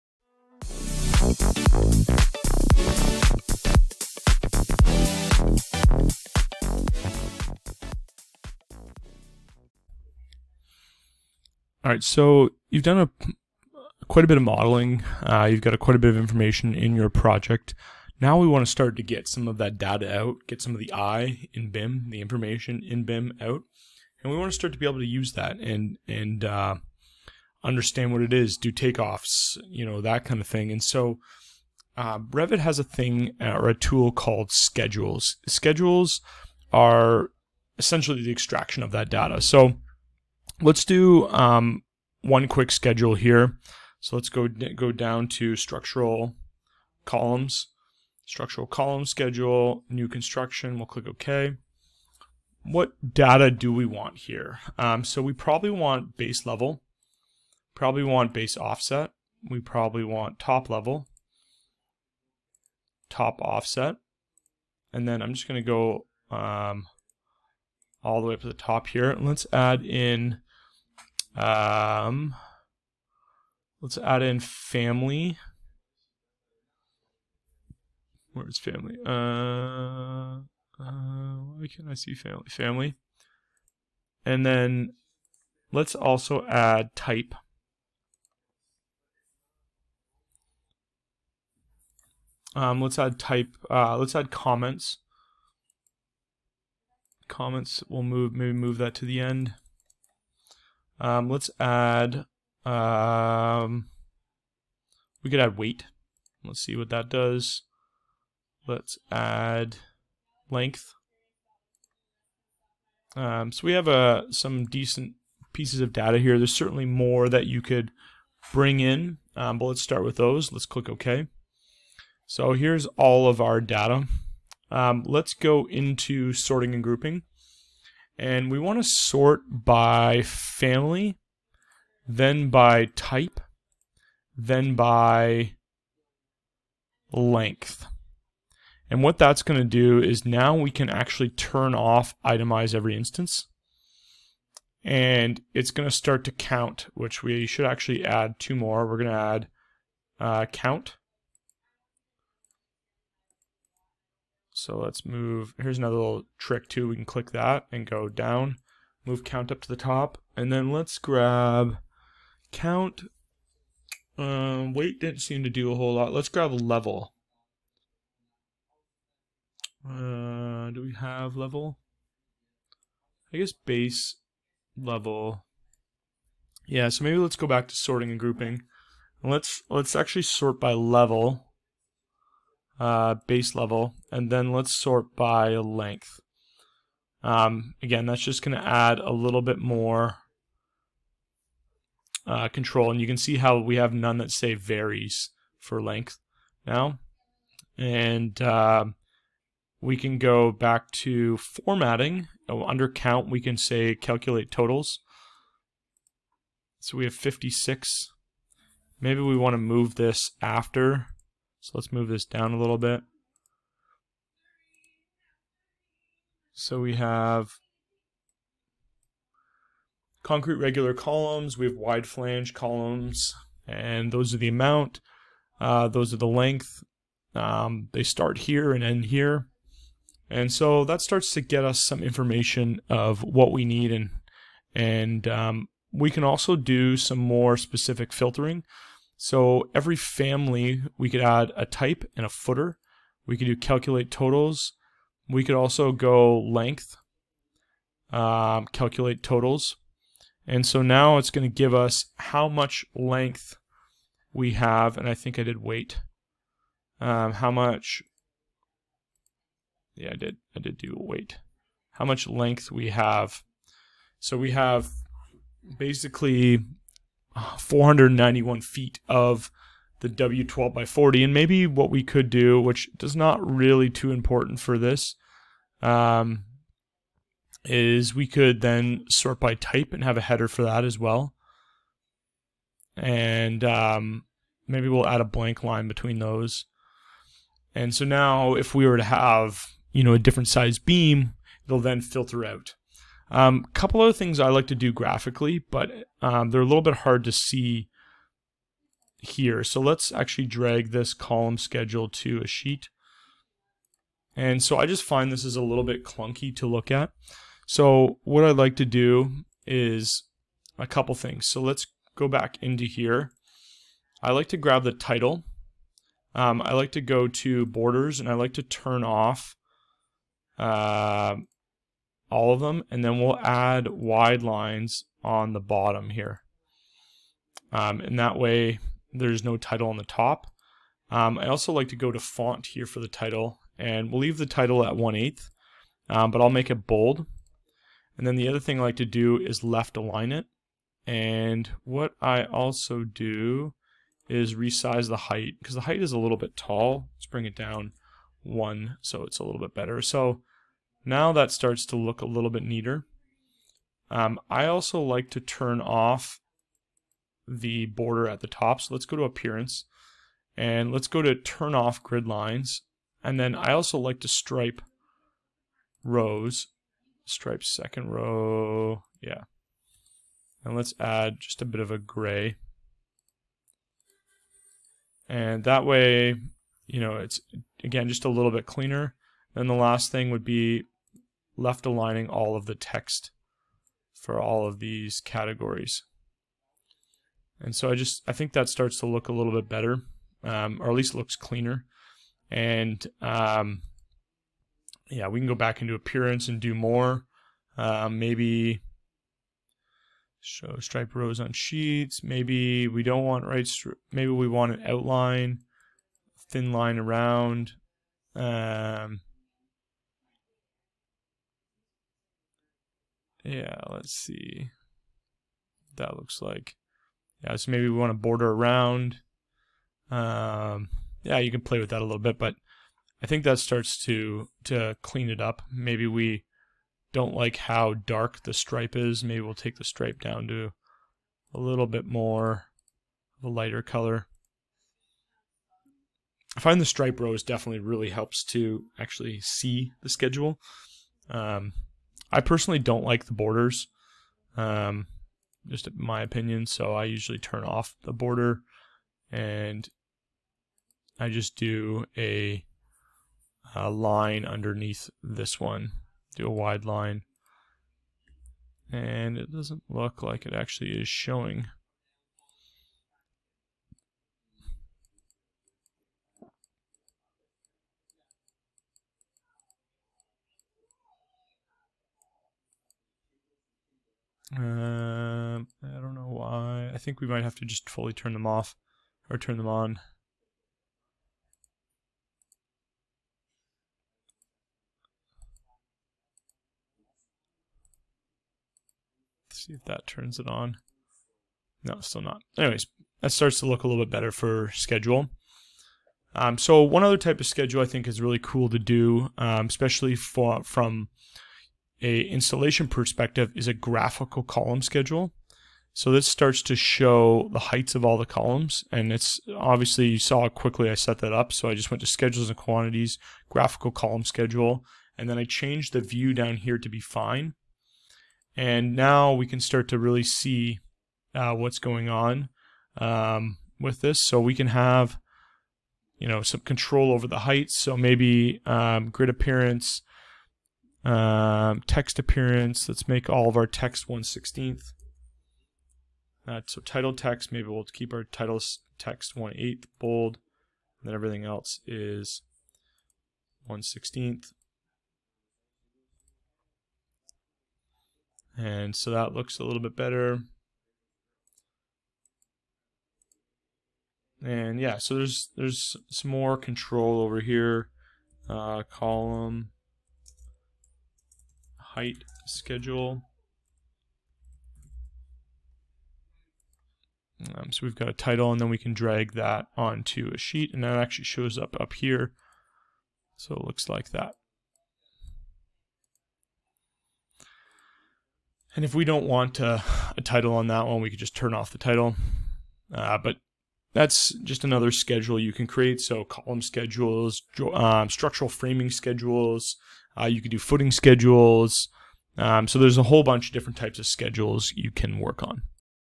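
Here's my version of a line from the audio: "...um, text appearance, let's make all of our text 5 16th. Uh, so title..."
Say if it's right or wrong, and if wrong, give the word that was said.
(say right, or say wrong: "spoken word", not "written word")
wrong: "1", not "5".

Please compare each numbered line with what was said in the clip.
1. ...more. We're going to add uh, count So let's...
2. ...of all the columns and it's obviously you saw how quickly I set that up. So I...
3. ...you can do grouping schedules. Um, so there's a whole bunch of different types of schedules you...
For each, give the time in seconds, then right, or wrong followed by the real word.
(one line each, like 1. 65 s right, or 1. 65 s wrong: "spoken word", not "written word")
1. 148 s right
2. 507 s right
3. 590 s wrong: "footing", not "grouping".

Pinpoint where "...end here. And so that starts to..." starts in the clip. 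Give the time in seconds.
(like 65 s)
228 s.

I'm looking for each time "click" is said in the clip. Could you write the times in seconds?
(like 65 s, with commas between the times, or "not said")
50 s, 120 s, 157 s.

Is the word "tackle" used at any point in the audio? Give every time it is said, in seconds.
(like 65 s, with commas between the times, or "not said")
not said.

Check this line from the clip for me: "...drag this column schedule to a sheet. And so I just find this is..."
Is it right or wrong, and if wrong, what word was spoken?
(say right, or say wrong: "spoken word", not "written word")
right.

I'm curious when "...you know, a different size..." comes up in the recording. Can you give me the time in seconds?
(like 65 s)
289 s.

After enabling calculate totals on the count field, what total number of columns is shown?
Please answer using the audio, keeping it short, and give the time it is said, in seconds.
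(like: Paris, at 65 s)
56, at 207 s.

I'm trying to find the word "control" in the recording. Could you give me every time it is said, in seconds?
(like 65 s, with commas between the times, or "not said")
192 s, 526 s, 556 s.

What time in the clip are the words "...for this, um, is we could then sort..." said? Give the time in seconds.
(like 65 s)
274 s.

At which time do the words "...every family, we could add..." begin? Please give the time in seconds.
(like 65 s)
239 s.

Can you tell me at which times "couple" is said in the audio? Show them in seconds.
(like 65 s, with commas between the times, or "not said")
293 s, 310 s.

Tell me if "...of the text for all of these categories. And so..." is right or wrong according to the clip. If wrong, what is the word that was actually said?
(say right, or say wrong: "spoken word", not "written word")
right.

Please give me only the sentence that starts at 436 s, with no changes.
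I find the stripe rows definitely really helps to actually see the schedule.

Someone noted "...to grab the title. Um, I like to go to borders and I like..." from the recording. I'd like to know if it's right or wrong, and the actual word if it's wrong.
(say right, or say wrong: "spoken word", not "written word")
right.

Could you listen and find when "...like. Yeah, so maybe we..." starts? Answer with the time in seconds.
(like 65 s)
416 s.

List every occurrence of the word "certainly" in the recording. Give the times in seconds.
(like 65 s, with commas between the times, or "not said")
116 s.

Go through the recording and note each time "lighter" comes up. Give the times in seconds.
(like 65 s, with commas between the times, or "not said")
433 s.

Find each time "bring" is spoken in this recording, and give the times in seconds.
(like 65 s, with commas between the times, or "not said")
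118 s, 347 s.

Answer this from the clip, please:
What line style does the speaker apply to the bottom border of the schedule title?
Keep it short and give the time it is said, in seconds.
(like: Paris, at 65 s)
Wide lines, at 323 s.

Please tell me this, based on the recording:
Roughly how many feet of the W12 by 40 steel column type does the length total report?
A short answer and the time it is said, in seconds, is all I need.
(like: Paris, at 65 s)
491 feet, at 267 s.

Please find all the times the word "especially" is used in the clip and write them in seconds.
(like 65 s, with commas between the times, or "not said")
499 s.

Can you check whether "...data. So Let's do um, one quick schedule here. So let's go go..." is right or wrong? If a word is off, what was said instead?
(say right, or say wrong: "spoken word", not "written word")
right.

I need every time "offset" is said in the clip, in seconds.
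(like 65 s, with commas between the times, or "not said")
58 s, 63 s.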